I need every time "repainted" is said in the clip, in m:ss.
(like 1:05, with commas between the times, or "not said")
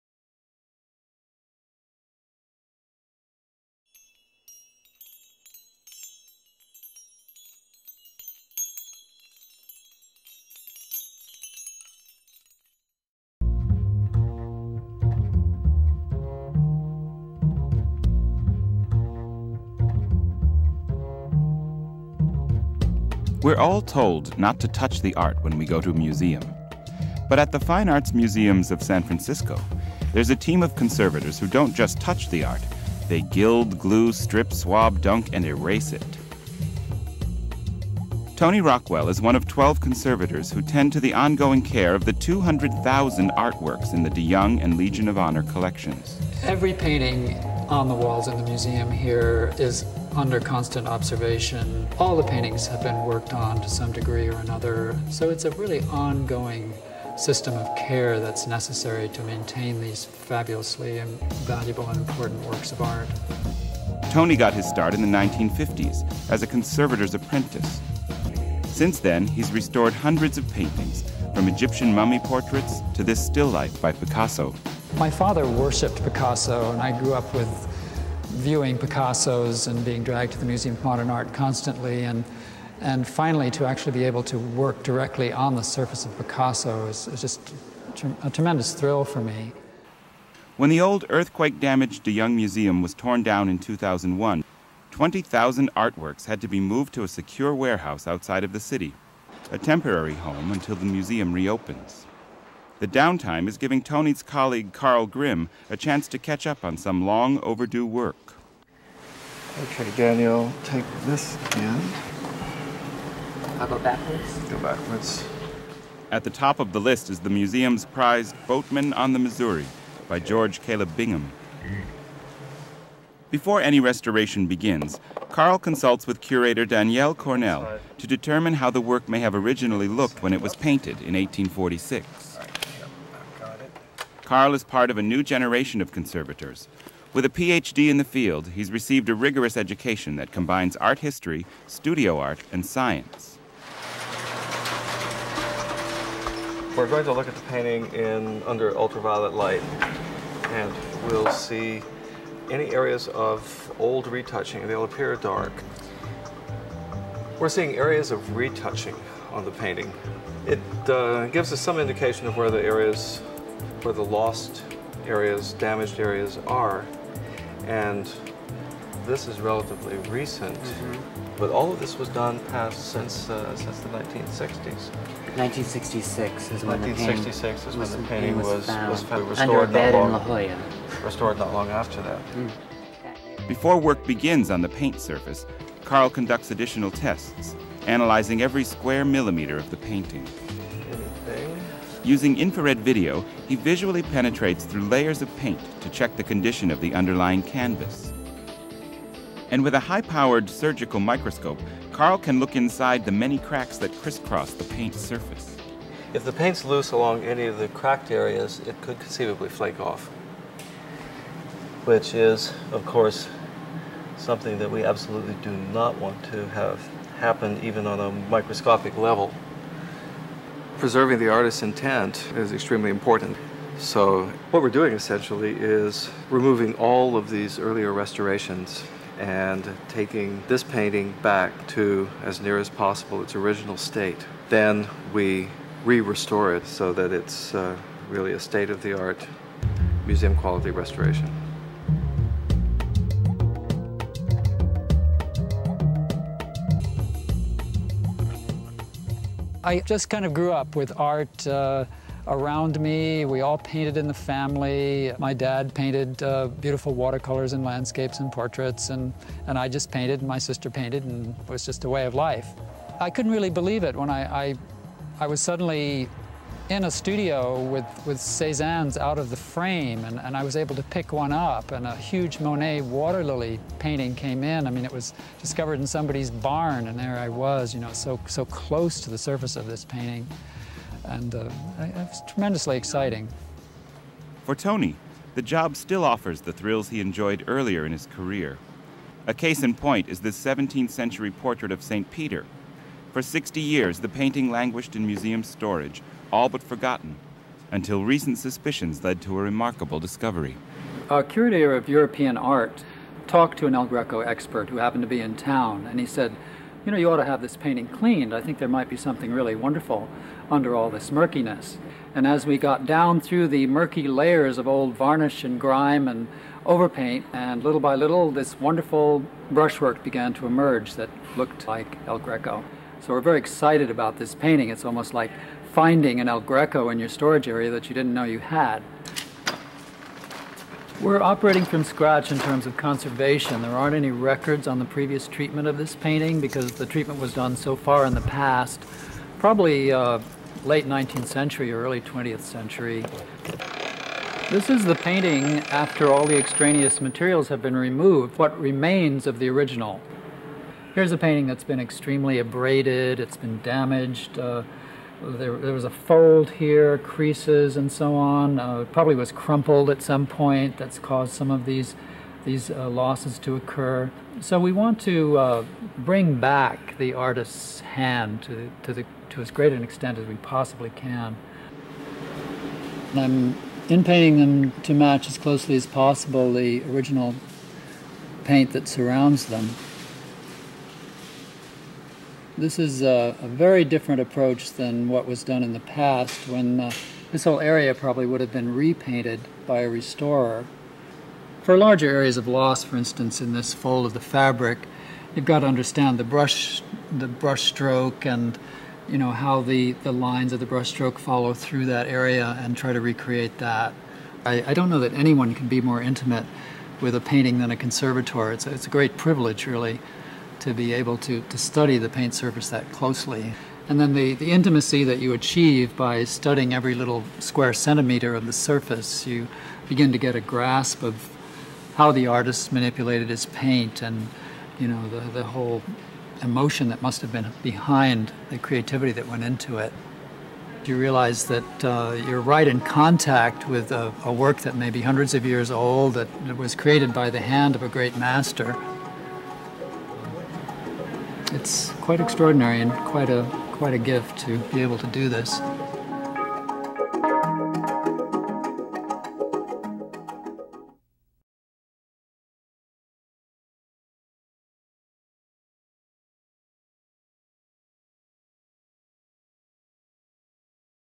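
6:28.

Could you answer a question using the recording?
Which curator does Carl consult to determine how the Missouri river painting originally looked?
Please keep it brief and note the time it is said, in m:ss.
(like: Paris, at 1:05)
Danielle Cornell, at 2:06.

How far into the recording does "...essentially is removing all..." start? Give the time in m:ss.
3:44.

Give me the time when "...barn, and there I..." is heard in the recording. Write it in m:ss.
4:36.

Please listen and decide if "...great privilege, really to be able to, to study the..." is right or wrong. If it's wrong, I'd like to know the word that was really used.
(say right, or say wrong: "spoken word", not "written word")
right.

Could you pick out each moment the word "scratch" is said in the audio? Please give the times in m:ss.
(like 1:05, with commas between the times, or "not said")
5:31.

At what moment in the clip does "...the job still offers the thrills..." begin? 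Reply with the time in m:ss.
4:45.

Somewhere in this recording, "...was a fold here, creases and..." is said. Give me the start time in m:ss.
5:55.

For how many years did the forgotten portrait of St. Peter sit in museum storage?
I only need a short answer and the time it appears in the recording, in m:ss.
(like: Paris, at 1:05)
60, at 4:53.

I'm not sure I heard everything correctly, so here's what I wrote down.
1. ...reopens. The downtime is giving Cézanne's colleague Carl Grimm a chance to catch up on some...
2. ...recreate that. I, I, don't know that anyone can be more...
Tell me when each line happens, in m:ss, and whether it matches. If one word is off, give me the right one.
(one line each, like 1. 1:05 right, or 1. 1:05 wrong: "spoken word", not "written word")
1. 1:41 wrong: "Tony", not "Cézanne"
2. 6:43 right.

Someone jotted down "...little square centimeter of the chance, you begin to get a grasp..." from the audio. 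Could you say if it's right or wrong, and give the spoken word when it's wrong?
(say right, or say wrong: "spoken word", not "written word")
wrong: "surface", not "chance".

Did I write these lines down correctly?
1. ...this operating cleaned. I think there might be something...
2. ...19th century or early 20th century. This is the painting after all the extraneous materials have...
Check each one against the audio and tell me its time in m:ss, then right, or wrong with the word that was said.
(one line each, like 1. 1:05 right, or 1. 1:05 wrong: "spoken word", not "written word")
1. 5:07 wrong: "painting", not "operating"
2. 5:40 right.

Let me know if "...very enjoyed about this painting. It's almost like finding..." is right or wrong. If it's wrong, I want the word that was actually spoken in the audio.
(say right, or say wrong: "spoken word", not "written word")
wrong: "excited", not "enjoyed".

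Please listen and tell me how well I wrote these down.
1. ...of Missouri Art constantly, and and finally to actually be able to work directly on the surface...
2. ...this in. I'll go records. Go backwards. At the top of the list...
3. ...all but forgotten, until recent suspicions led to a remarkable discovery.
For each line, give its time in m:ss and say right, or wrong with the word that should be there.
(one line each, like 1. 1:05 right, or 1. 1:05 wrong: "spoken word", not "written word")
1. 1:20 wrong: "Modern", not "Missouri"
2. 1:51 wrong: "backwards", not "records"
3. 4:56 right.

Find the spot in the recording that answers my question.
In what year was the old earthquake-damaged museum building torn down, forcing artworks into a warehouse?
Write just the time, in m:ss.
1:33.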